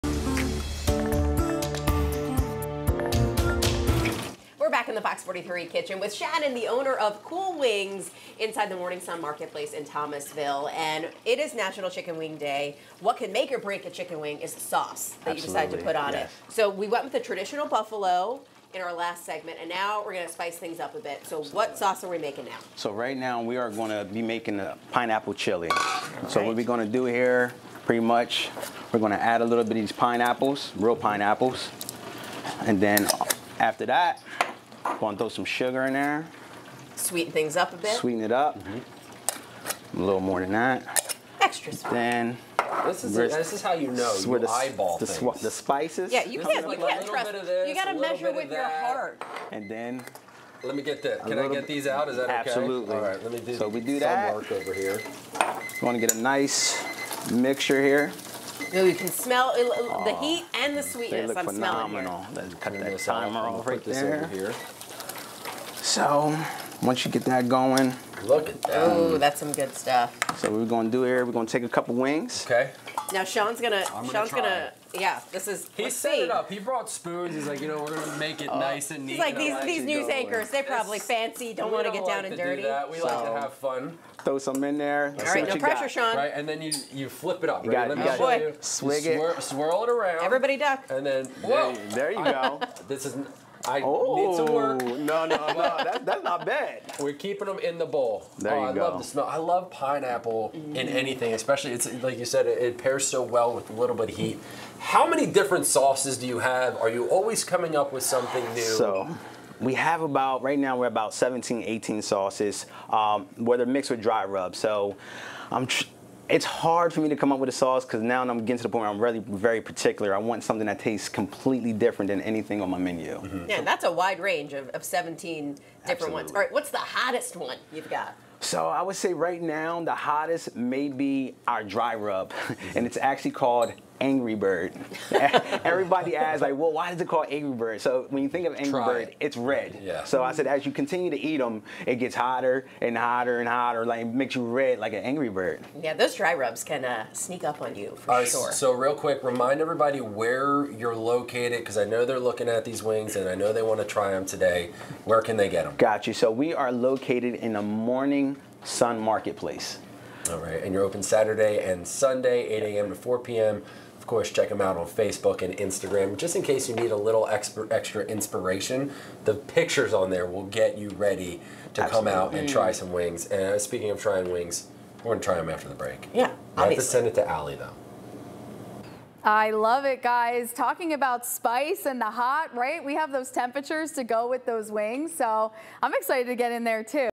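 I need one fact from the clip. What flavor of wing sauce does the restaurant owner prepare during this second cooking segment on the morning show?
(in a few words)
Pineapple chili.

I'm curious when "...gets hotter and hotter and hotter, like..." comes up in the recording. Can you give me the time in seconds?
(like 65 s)
141 s.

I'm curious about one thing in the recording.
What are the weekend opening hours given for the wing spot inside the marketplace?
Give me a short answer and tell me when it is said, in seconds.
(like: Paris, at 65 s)
8 a.m. to 4 p.m., at 162 s.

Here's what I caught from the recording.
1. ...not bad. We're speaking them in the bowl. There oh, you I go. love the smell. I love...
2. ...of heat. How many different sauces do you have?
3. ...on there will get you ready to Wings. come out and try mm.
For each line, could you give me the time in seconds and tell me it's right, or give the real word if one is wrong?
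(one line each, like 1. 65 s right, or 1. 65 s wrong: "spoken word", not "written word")
1. 96 s wrong: "keeping", not "speaking"
2. 104 s right
3. 169 s wrong: "Absolutely", not "Wings".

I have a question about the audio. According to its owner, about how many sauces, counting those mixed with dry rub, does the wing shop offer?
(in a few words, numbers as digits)
17 to 18.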